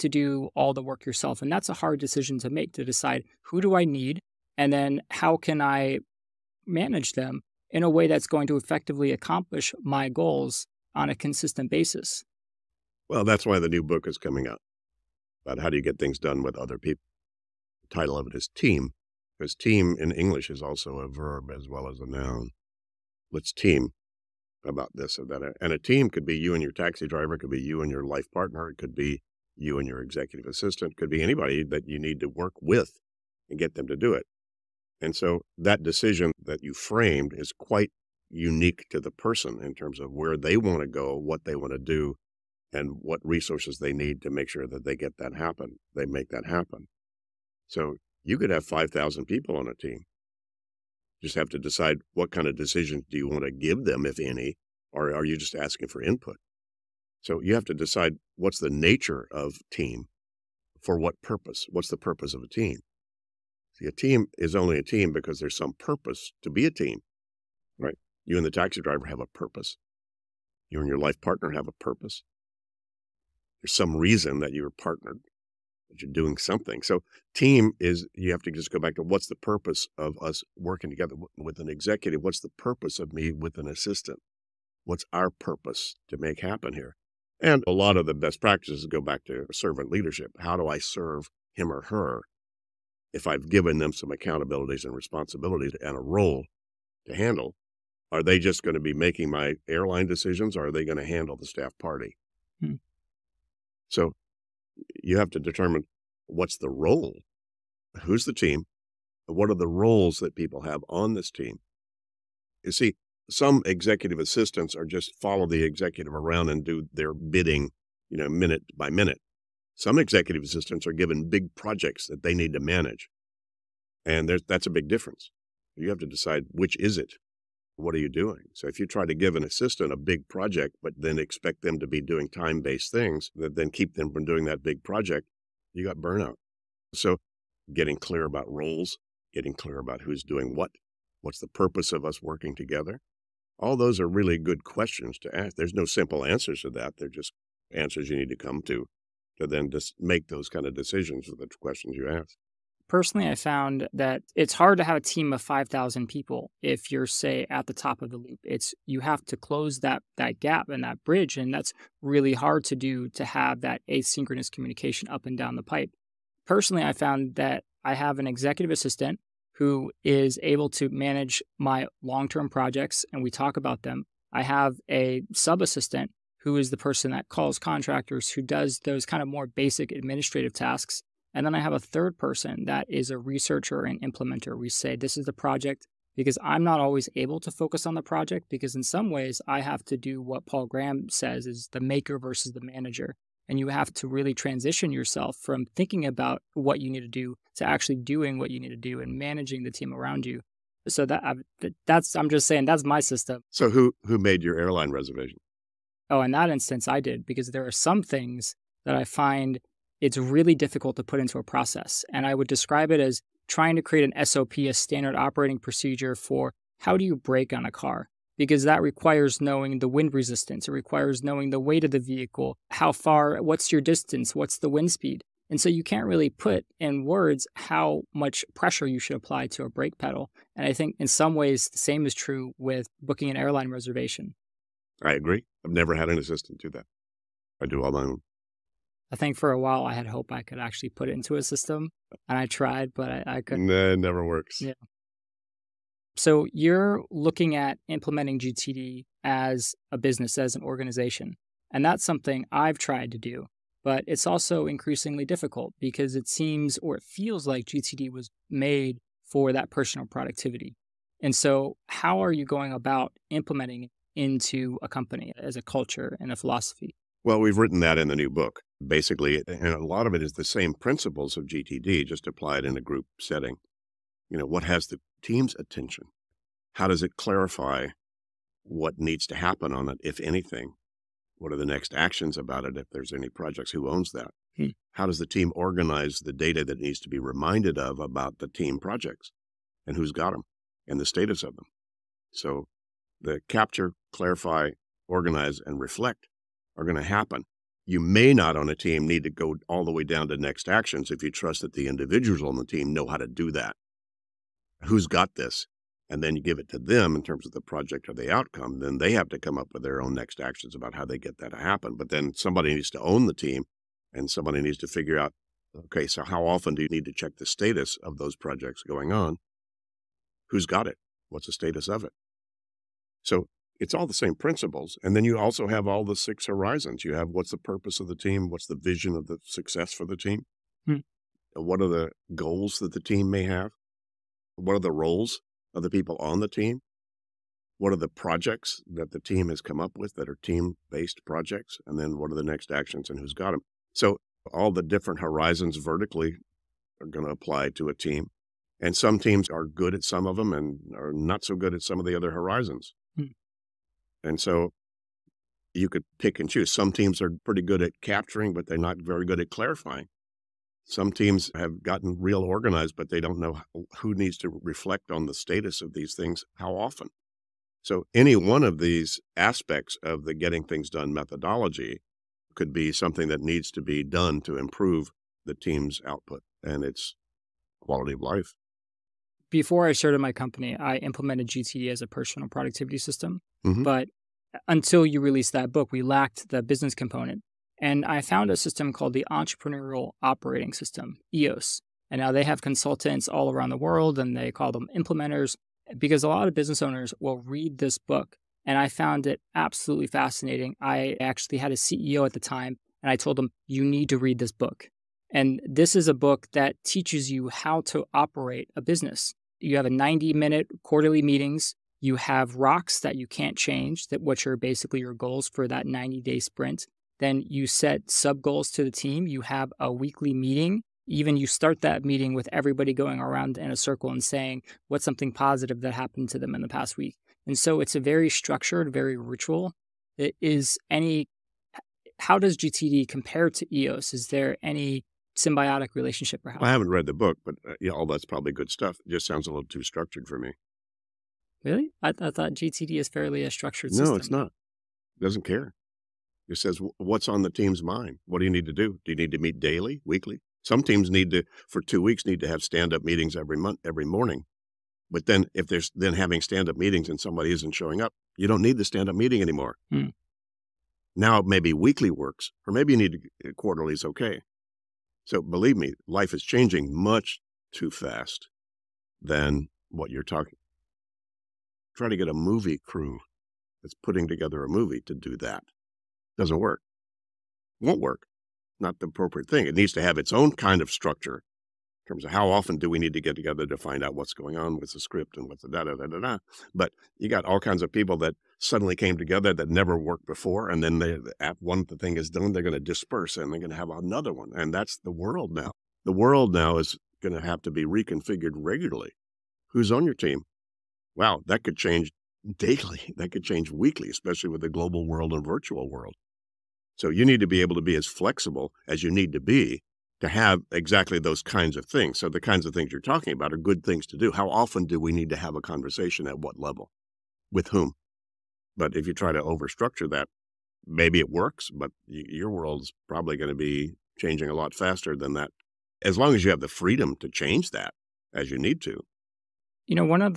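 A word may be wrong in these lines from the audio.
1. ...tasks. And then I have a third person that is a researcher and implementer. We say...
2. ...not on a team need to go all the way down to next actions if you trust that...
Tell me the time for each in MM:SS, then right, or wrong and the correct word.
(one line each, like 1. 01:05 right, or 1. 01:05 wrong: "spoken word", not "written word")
1. 03:00 right
2. 04:58 right.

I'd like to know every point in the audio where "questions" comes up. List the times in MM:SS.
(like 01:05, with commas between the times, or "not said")
02:24, 02:31.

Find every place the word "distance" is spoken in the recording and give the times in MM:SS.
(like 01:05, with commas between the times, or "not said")
03:43.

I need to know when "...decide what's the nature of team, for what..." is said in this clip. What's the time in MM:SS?
00:57.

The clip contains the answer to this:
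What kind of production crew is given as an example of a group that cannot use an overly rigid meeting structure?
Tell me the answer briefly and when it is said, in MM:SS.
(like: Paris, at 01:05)
A movie crew, at 07:52.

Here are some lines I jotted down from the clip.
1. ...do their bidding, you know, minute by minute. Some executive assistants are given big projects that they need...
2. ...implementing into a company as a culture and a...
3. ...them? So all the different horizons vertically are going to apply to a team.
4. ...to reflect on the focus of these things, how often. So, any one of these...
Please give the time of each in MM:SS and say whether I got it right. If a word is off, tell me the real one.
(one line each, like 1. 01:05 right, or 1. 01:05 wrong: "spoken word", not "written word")
1. 01:56 right
2. 04:23 right
3. 05:43 right
4. 06:04 wrong: "status", not "focus".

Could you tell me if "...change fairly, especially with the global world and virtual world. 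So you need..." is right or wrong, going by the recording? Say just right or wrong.
wrong.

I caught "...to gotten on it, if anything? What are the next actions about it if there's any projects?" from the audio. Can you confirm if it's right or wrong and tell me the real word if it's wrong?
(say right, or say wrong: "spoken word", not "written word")
wrong: "happen", not "gotten".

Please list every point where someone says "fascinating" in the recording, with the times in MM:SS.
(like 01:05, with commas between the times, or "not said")
06:40.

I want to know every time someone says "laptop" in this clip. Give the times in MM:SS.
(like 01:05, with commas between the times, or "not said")
not said.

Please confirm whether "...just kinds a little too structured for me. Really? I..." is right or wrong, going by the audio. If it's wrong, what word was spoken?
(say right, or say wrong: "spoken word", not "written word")
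wrong: "sounds", not "kinds".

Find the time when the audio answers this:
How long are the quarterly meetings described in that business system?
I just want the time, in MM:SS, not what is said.
06:49.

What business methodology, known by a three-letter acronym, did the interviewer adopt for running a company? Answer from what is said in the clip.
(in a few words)
Entrepreneurial Operating System.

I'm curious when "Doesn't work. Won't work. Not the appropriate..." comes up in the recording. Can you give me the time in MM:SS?
07:56.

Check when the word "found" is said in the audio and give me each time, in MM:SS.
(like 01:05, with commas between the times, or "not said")
02:33, 02:46, 06:28, 06:38.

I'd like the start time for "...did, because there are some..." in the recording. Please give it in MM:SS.
03:26.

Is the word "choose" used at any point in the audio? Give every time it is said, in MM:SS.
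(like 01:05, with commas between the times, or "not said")
05:56.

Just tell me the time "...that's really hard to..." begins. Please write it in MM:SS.
02:41.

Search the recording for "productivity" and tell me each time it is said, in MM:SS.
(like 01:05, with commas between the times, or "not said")
04:20, 06:22.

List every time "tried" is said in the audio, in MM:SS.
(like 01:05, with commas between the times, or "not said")
04:02, 04:12.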